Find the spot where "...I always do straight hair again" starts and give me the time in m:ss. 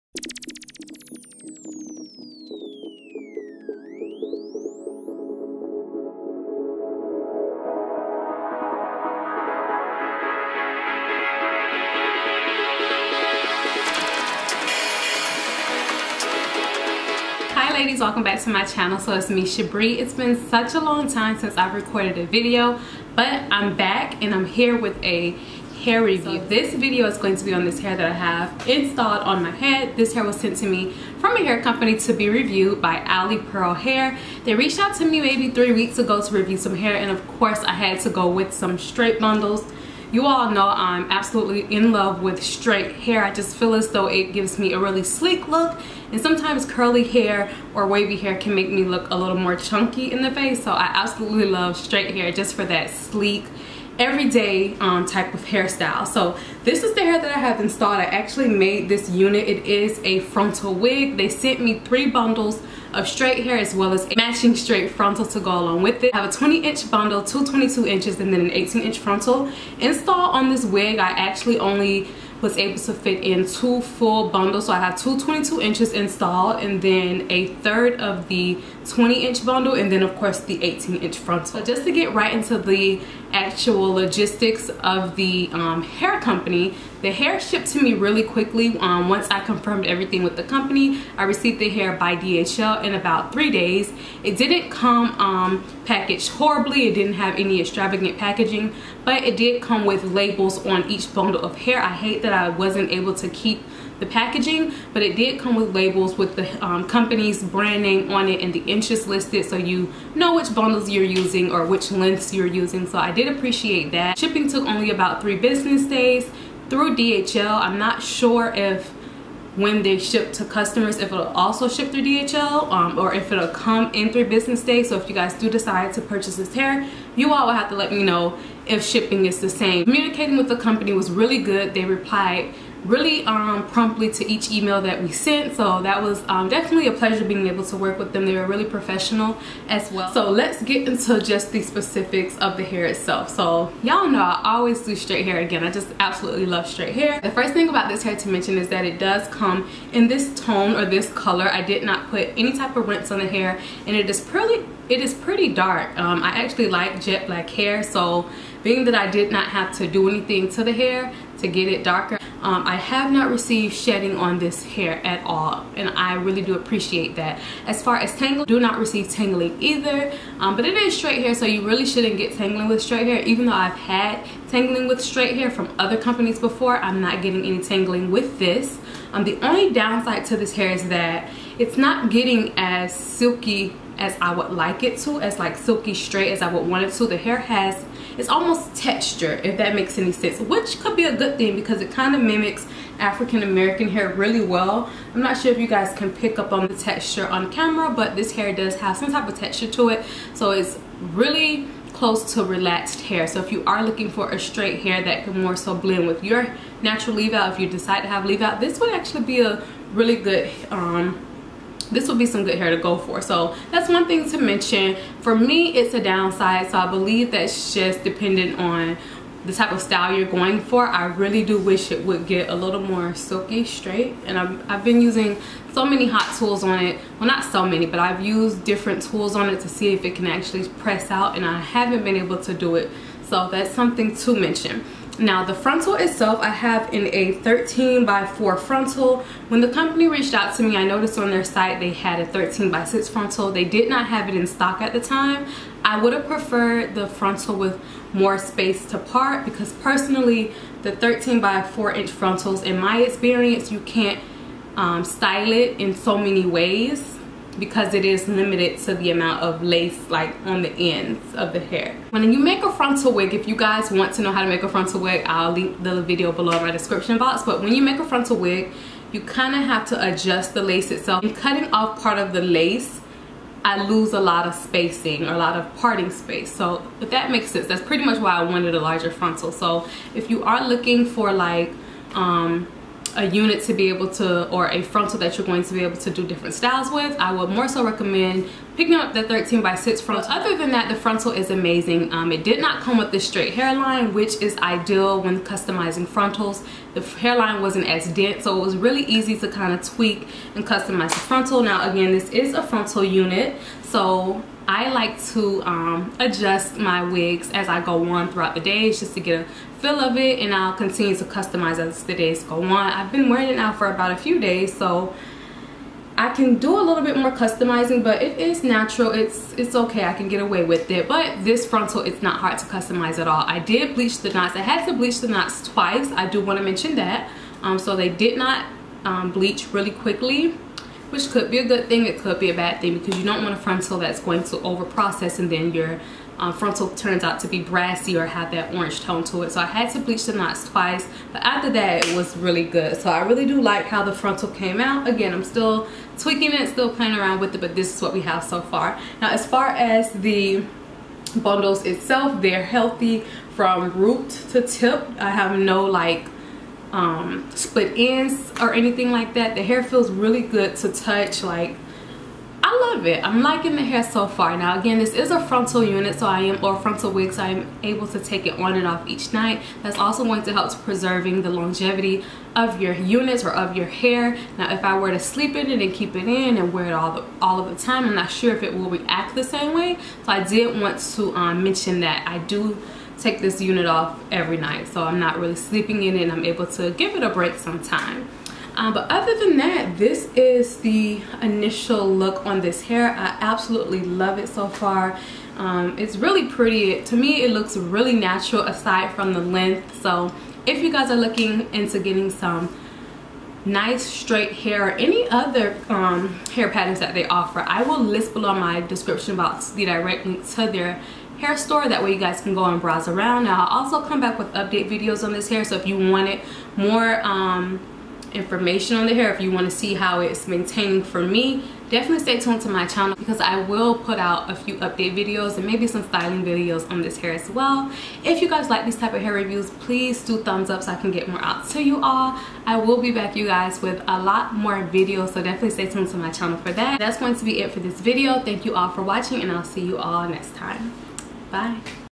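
2:24.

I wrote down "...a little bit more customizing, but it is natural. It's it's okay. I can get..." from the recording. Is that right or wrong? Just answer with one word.
right.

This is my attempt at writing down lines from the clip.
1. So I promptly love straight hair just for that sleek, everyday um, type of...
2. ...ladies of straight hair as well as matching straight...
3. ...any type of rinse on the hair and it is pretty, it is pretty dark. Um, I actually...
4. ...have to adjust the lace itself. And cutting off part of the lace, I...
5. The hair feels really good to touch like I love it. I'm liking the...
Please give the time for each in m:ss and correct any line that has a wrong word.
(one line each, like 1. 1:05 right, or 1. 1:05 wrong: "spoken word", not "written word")
1. 0:50 wrong: "absolutely", not "promptly"
2. 1:02 wrong: "bundles", not "ladies"
3. 2:32 right
4. 4:29 right
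5. 5:59 right.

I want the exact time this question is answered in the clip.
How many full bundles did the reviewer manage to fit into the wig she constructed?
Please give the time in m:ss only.
1:13.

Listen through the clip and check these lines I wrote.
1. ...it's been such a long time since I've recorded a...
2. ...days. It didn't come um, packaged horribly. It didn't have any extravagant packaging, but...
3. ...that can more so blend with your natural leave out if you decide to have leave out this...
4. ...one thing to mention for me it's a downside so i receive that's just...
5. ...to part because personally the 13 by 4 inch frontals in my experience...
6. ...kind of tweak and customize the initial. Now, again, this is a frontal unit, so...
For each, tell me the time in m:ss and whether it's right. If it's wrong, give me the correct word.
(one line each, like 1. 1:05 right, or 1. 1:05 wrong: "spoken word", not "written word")
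1. 0:19 right
2. 1:33 right
3. 3:25 right
4. 3:33 wrong: "believe", not "receive"
5. 4:08 right
6. 4:59 wrong: "frontal", not "initial".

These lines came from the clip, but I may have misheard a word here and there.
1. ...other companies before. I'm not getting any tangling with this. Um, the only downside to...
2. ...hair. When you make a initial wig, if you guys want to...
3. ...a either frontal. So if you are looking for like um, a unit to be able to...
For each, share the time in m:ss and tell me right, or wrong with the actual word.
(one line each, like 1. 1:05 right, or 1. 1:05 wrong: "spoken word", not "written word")
1. 2:55 right
2. 4:21 wrong: "frontal", not "initial"
3. 4:38 wrong: "larger", not "either".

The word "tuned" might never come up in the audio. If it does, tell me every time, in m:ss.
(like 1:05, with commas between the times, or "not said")
7:02, 7:15.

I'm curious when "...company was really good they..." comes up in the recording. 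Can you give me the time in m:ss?
2:10.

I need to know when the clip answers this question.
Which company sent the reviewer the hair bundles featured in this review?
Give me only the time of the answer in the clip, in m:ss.
0:33.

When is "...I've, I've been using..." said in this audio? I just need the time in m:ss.
3:44.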